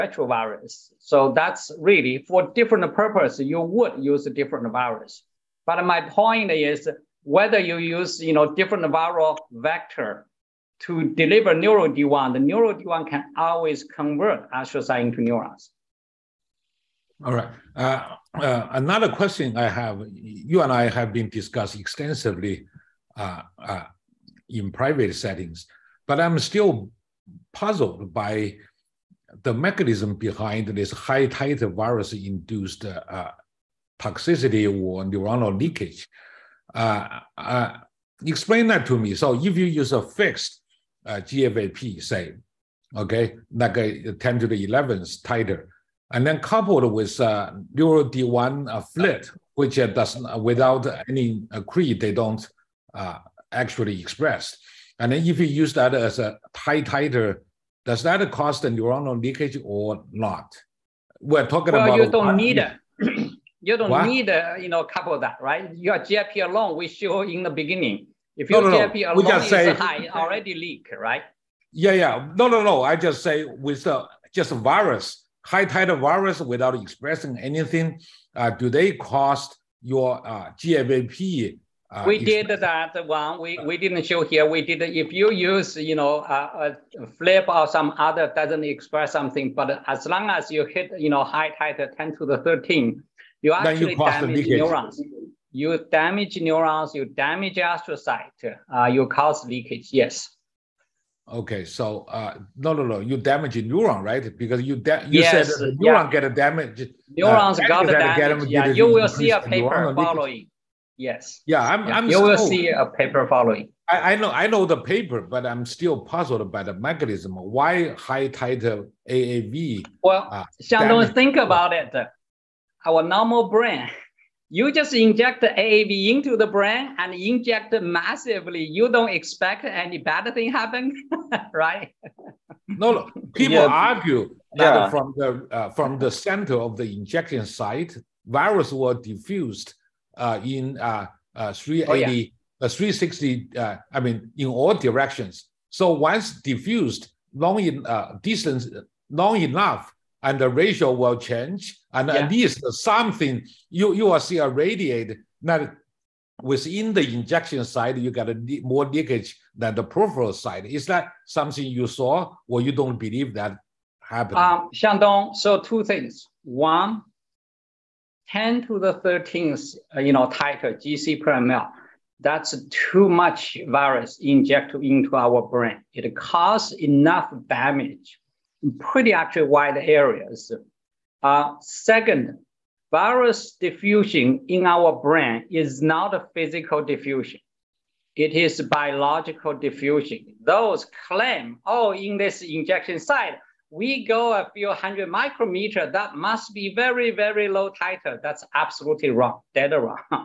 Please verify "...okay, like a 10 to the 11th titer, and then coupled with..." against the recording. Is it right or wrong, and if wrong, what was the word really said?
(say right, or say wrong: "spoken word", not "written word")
right.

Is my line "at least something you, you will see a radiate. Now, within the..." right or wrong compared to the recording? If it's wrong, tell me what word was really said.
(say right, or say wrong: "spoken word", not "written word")
right.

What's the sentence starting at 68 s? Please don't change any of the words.
If your no, no, GIP alone is say, high, already leak, right?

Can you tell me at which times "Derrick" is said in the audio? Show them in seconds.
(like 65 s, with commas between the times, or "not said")
not said.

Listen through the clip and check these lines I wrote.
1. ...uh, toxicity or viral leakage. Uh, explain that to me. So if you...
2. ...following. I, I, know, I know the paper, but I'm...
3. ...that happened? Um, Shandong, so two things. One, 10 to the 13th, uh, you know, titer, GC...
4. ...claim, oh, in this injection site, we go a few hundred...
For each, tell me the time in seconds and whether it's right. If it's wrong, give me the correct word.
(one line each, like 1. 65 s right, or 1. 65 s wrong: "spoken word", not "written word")
1. 32 s wrong: "neuronal", not "viral"
2. 113 s right
3. 163 s right
4. 191 s right.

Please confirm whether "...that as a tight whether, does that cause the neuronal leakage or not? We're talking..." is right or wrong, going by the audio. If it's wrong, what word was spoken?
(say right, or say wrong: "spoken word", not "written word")
wrong: "titer", not "whether".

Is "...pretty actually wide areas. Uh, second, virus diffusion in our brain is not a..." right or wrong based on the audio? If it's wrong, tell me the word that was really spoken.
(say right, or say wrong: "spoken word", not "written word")
right.